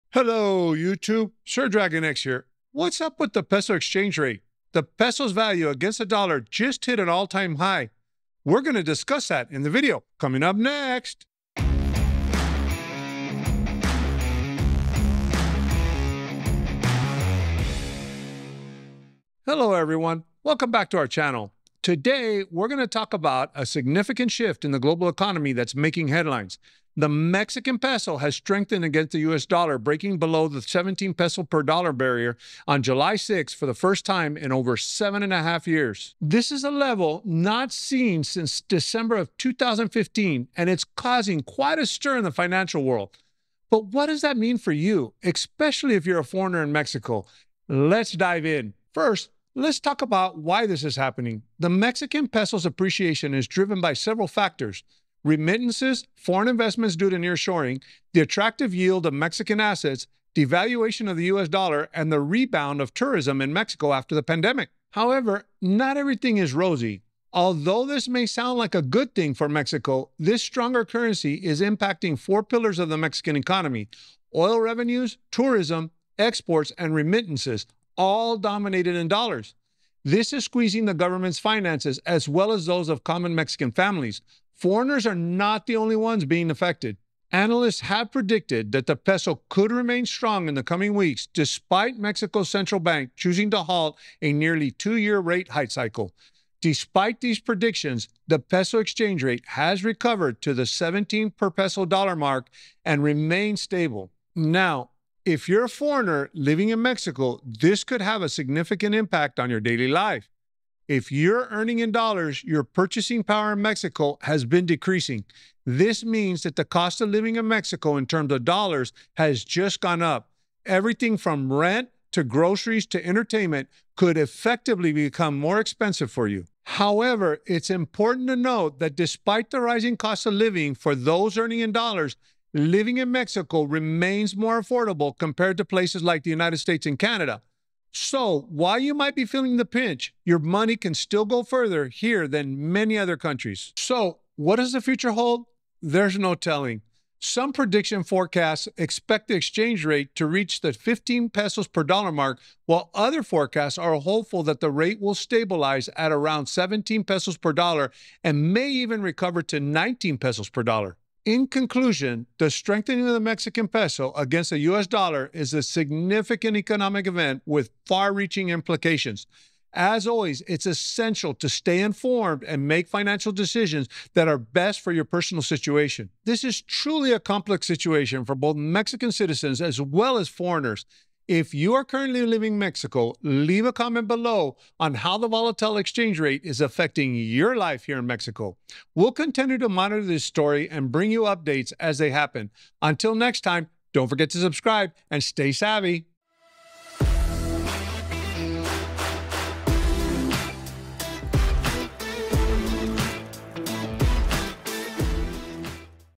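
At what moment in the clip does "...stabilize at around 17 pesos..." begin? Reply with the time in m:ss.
2:35.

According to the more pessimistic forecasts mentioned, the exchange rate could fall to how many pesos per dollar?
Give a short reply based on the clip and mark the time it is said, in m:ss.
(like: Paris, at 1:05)
15, at 2:30.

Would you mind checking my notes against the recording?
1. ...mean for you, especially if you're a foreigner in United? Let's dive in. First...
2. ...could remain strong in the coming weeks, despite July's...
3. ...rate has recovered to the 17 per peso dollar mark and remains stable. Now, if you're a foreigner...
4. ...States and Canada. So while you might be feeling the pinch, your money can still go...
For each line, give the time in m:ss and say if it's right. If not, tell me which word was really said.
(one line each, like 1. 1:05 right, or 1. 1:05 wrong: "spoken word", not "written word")
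1. 0:44 wrong: "Mexico", not "United"
2. 1:29 wrong: "Mexico", not "July"
3. 1:39 right
4. 2:16 right.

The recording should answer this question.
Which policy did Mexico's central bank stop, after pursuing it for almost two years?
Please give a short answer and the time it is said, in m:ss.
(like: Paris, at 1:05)
rate hike cycle, at 1:35.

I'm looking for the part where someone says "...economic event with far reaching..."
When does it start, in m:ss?
2:46.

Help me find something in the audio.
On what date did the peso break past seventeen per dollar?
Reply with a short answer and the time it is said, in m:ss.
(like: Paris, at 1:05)
July 6, at 0:32.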